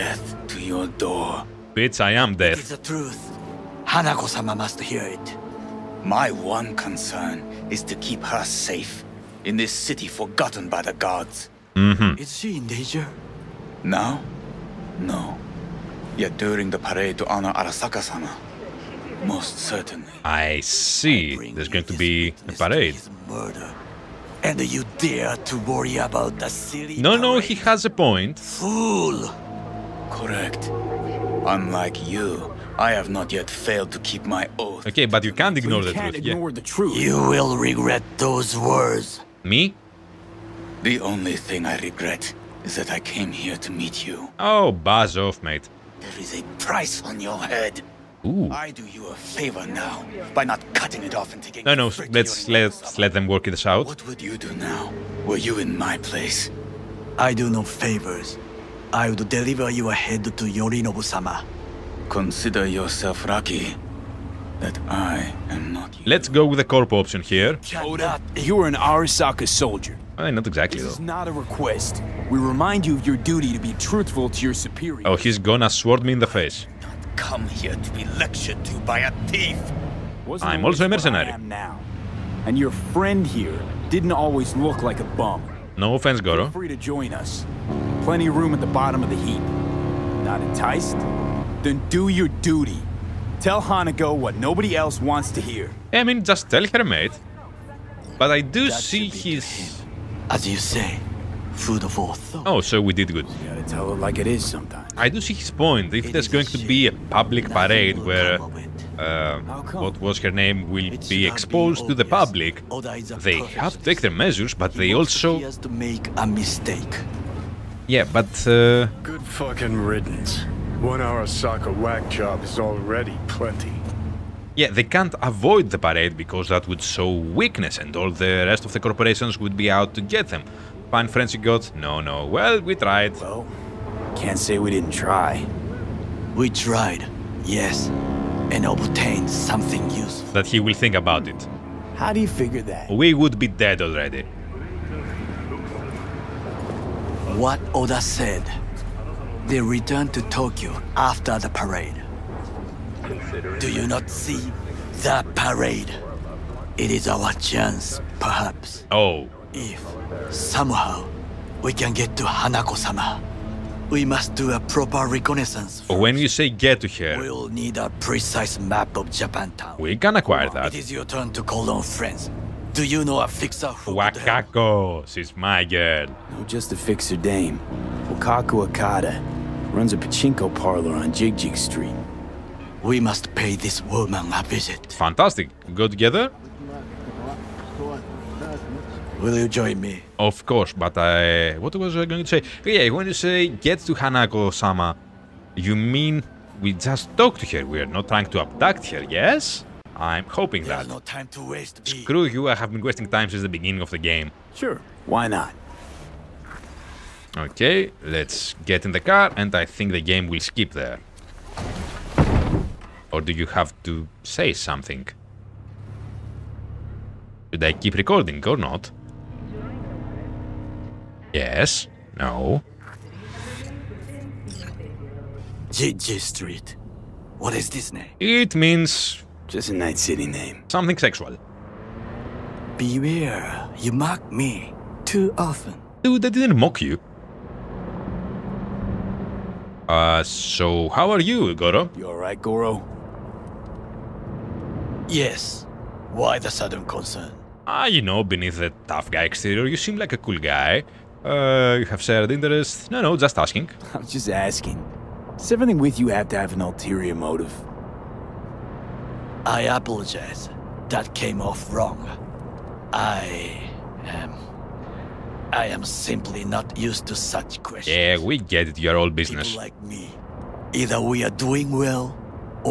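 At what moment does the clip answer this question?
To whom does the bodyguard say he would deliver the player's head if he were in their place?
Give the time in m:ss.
1:00.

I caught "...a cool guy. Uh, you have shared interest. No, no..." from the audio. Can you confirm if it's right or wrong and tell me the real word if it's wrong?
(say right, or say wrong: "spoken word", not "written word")
right.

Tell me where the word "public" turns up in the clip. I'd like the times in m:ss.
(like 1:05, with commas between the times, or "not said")
1:47, 1:52.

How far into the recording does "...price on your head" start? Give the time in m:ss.
0:46.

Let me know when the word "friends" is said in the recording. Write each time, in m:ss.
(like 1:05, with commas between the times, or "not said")
1:22, 2:11, 2:51.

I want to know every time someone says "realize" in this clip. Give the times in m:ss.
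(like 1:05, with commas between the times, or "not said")
not said.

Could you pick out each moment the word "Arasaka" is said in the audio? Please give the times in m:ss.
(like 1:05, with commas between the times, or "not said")
0:17, 1:08, 2:00.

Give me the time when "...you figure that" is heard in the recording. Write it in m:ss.
2:22.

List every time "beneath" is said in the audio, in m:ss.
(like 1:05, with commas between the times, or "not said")
4:08.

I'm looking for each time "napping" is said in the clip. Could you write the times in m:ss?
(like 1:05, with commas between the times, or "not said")
not said.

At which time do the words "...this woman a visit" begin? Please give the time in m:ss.
3:03.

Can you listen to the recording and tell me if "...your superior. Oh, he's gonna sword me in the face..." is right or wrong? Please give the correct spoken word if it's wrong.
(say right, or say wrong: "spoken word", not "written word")
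right.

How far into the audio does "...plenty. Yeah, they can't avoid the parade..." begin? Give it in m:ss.
2:03.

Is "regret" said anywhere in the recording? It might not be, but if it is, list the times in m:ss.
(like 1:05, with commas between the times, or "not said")
0:37, 0:41.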